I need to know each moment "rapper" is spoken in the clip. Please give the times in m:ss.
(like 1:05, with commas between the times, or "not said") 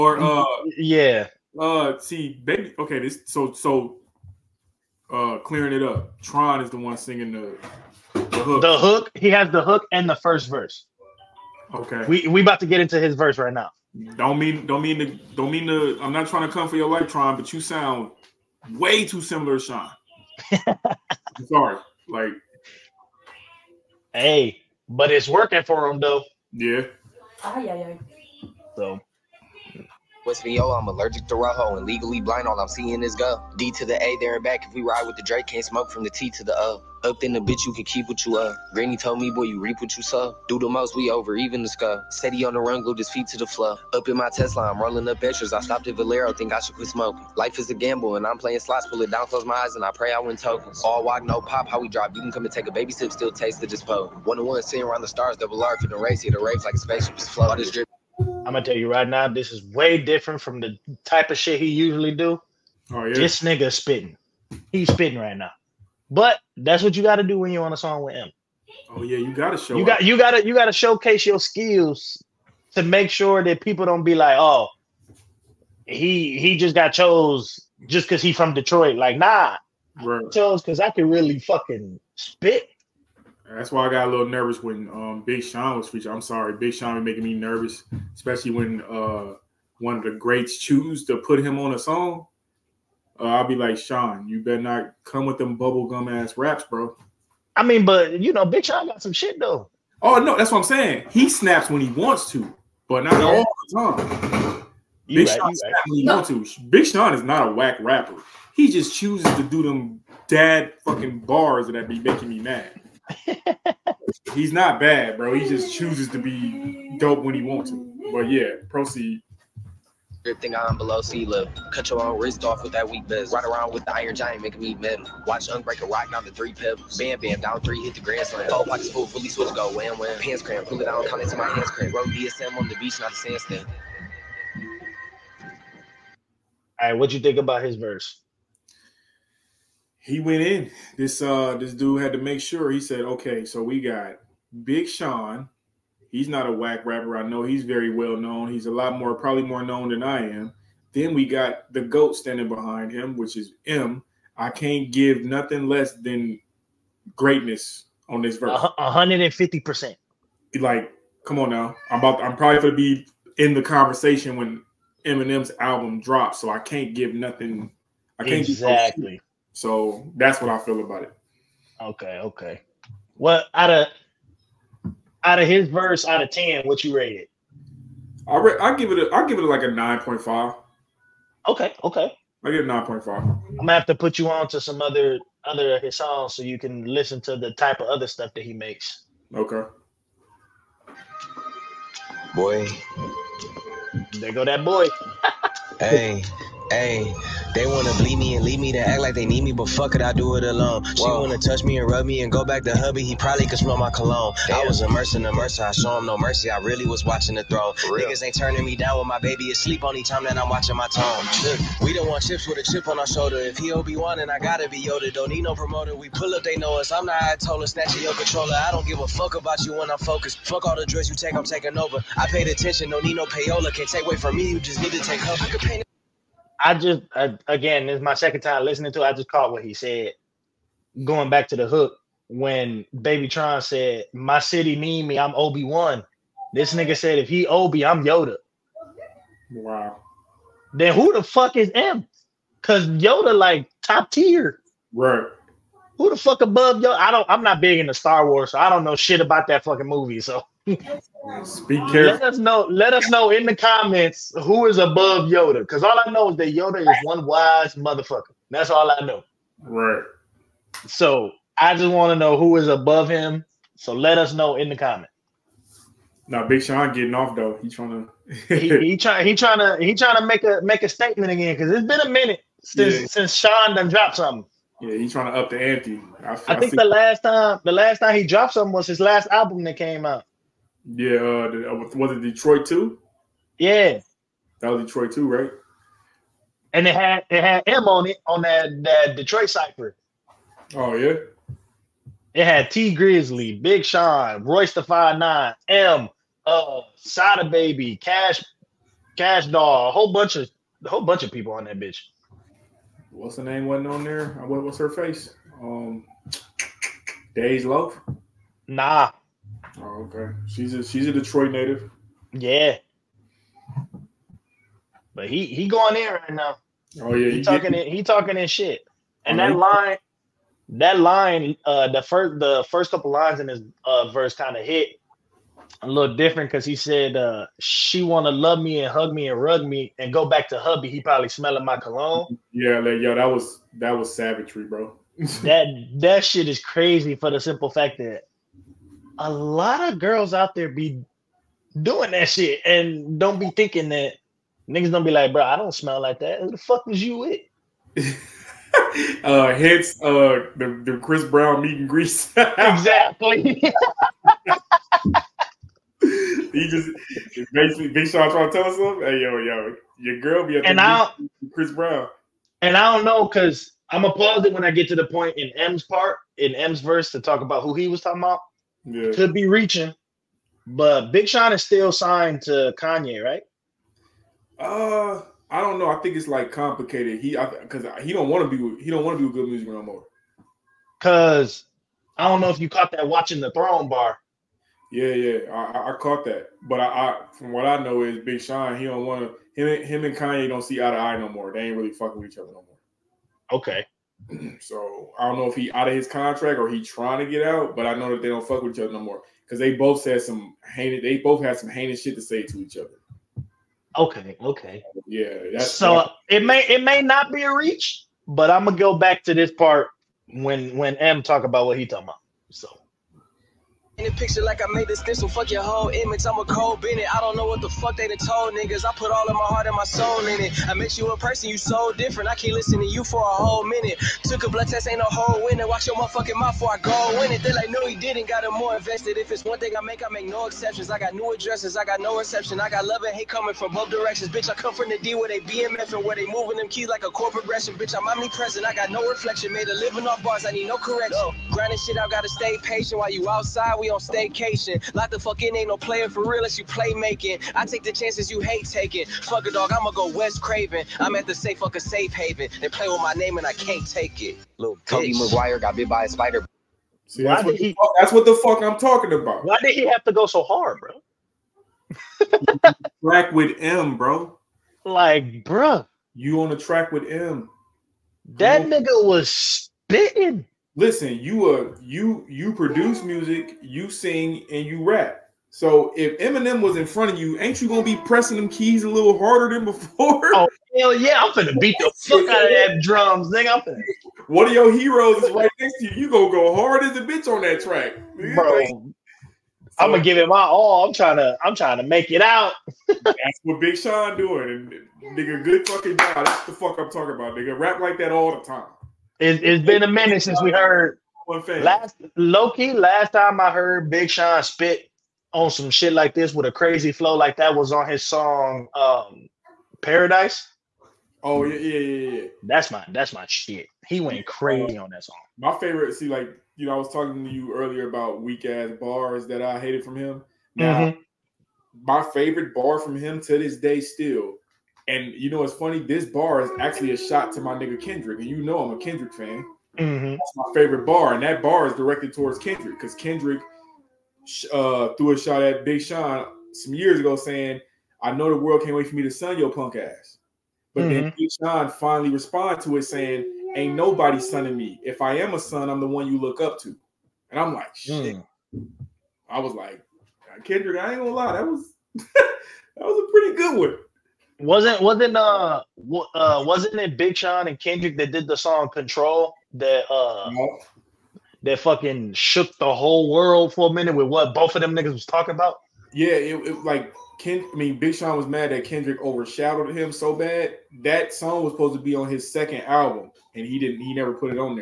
1:47, 2:26.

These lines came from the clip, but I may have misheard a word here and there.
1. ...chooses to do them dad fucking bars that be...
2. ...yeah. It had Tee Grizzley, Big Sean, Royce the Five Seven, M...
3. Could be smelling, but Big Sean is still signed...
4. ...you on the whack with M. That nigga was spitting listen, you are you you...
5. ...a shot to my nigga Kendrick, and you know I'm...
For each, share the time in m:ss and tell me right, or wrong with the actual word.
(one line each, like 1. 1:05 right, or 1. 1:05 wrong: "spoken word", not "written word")
1. 1:48 right
2. 4:50 wrong: "Nine", not "Seven"
3. 6:09 wrong: "reaching", not "smelling"
4. 7:46 wrong: "track", not "whack"
5. 8:46 right.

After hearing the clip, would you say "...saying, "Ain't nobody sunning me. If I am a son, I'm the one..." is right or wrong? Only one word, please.
right.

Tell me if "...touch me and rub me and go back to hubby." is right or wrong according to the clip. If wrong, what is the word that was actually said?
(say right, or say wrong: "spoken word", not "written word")
right.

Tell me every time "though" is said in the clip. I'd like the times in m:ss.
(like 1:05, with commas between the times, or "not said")
0:25, 1:39, 4:27.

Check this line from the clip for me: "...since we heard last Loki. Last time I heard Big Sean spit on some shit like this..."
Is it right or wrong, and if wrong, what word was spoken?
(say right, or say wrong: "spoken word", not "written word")
right.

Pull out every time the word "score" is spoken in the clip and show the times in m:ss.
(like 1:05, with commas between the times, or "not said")
0:41.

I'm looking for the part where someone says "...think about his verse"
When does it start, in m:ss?
2:17.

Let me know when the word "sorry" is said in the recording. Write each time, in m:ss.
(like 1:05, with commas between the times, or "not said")
0:21, 1:26.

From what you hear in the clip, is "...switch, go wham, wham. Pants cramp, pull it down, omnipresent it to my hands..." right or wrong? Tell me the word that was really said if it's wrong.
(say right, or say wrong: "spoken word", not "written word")
wrong: "count", not "omnipresent".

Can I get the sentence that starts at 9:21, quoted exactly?
that fucking shook the whole world for a minute with what both of them niggas was talking about?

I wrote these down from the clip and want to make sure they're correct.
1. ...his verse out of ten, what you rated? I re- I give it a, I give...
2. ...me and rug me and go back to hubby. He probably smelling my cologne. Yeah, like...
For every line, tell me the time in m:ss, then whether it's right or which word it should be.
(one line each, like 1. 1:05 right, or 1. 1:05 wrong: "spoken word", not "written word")
1. 2:55 right
2. 5:29 right.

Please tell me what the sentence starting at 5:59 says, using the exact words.
Hey yo, yo, your girl be up and I Chris Brown.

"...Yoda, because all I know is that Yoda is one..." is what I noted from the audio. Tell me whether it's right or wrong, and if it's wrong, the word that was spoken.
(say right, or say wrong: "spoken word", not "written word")
right.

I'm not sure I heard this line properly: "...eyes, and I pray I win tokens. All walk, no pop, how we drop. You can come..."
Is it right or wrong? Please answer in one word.
right.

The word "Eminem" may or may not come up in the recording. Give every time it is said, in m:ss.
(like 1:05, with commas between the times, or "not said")
2:45, 7:56.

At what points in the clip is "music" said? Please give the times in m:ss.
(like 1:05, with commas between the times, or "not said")
6:19, 7:53.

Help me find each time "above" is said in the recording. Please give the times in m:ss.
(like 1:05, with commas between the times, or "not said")
4:06, 4:14, 4:22.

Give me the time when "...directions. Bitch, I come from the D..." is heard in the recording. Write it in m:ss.
7:13.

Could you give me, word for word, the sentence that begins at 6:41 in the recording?
They both had some heinous shit to say to each other.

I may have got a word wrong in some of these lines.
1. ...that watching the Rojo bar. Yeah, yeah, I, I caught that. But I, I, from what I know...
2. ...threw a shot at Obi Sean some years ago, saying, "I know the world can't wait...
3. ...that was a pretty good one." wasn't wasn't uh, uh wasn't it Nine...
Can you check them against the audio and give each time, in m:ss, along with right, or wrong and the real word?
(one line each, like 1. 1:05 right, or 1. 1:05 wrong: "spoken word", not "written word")
1. 6:22 wrong: "Throne", not "Rojo"
2. 8:54 wrong: "Big", not "Obi"
3. 9:11 wrong: "Big", not "Nine".